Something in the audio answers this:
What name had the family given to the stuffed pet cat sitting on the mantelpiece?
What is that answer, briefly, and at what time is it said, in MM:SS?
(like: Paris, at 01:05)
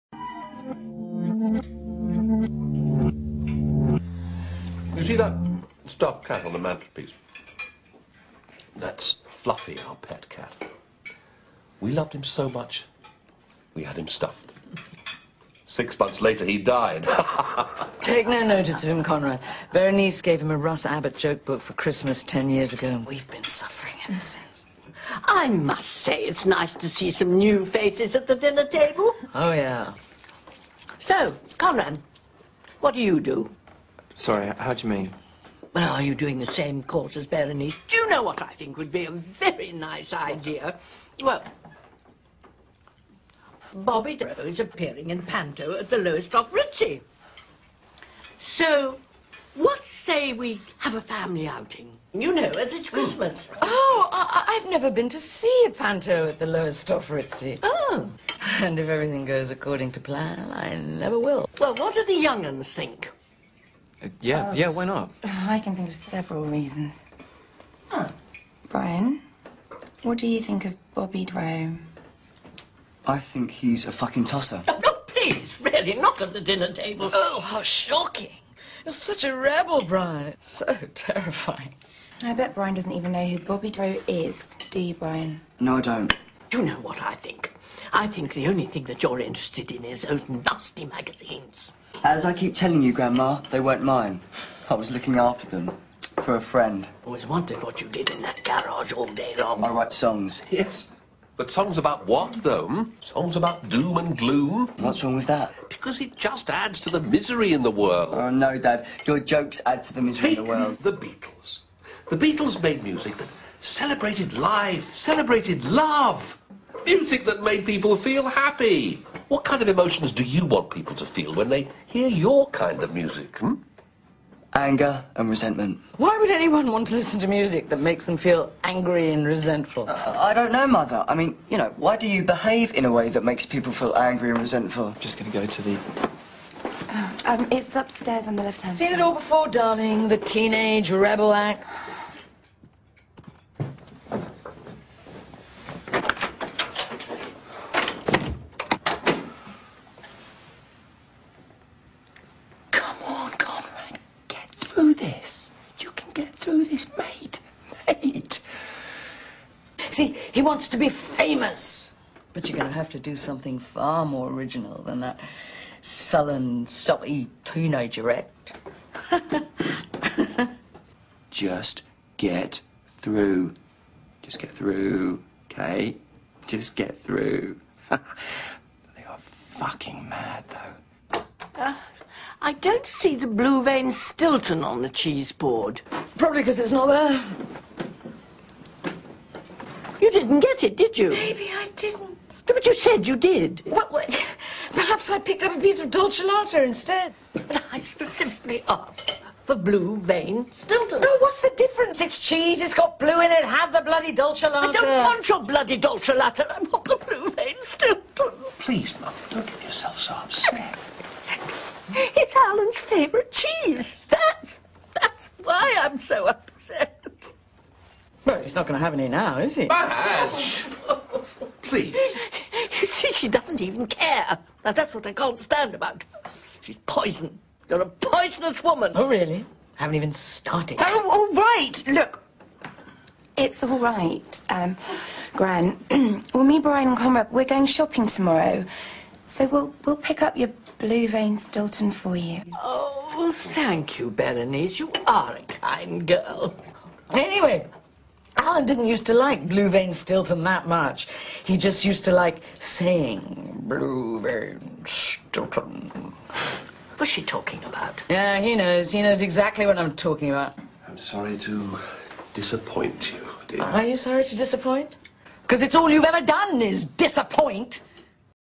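Fluffy, at 00:09.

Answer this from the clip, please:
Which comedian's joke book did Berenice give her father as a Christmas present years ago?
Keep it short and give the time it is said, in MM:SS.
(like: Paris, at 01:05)
Russ Abbott, at 00:20.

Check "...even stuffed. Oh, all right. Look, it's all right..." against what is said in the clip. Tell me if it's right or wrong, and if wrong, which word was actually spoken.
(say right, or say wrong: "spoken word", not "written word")
wrong: "started", not "stuffed".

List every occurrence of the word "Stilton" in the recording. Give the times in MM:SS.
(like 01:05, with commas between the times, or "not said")
03:03, 03:20, 03:27, 04:01, 04:09, 04:14.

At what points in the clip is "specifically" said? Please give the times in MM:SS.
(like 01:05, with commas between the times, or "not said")
03:17.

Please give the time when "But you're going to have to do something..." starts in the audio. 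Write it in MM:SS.
02:42.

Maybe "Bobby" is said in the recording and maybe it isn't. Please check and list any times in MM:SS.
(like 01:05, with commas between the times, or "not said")
00:43, 01:10, 01:23.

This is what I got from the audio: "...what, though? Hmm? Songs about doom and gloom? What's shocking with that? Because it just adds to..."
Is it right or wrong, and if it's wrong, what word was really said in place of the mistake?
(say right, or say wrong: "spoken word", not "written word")
wrong: "wrong", not "shocking".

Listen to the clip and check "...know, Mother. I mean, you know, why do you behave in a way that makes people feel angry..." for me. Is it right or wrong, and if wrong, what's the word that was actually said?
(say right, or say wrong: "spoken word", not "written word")
right.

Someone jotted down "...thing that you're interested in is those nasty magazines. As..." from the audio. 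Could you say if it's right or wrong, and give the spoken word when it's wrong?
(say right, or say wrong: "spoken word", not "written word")
right.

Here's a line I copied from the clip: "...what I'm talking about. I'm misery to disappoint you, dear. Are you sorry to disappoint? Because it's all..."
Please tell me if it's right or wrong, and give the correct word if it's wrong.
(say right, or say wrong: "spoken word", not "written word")
wrong: "sorry", not "misery".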